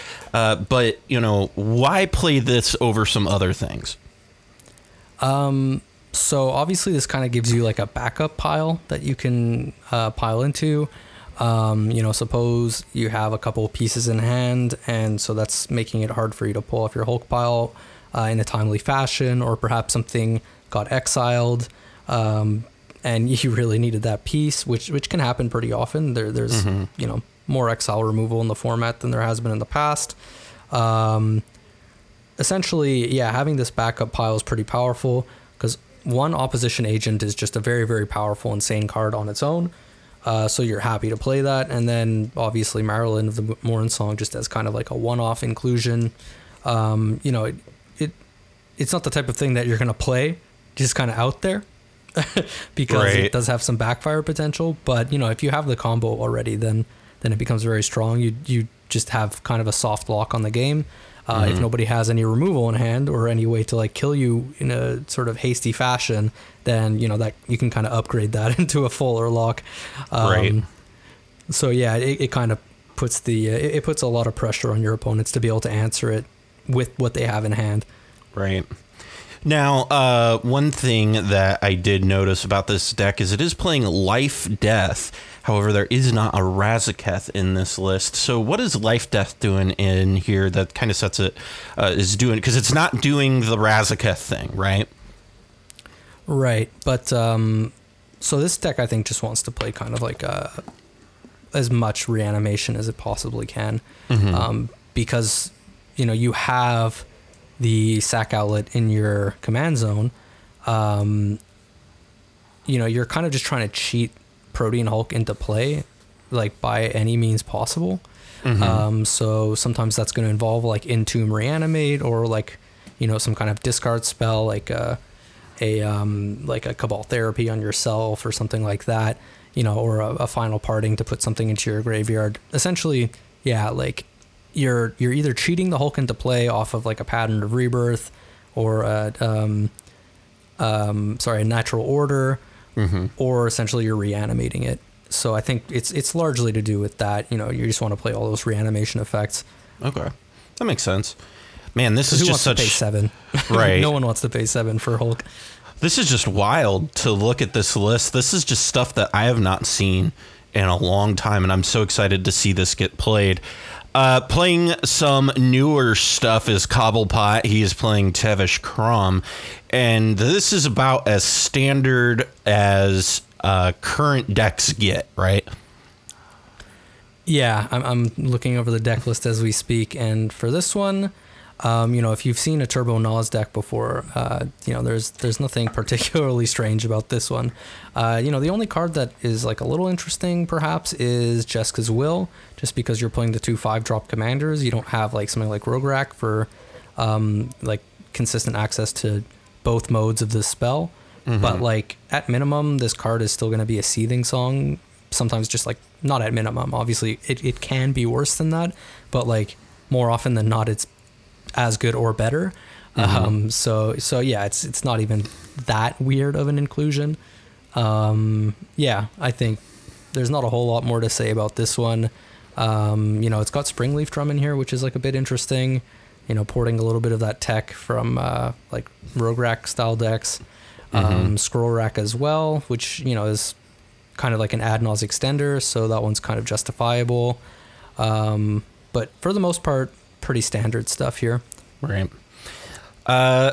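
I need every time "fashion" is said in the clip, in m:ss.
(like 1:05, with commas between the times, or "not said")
0:18, 1:05.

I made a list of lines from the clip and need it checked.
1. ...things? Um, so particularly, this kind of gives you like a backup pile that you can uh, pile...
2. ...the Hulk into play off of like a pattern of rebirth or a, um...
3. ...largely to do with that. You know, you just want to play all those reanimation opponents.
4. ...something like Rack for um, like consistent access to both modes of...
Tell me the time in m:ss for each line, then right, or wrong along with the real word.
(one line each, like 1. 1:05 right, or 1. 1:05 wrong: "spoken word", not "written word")
1. 0:03 wrong: "obviously", not "particularly"
2. 2:15 right
3. 2:26 wrong: "effects", not "opponents"
4. 3:15 right.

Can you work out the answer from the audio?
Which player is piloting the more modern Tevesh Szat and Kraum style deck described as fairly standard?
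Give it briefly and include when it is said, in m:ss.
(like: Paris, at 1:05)
Cobblepott, at 2:46.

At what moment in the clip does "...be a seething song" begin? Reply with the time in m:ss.
3:23.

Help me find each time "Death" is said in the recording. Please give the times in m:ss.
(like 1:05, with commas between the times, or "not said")
1:24, 1:29.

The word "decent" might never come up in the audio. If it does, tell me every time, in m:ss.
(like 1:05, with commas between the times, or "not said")
not said.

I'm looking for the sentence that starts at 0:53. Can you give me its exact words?
it does have some backfire potential.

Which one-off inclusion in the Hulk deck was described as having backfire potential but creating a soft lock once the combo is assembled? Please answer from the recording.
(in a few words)
Maralen of the Mornsong.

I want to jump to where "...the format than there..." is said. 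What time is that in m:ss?
0:28.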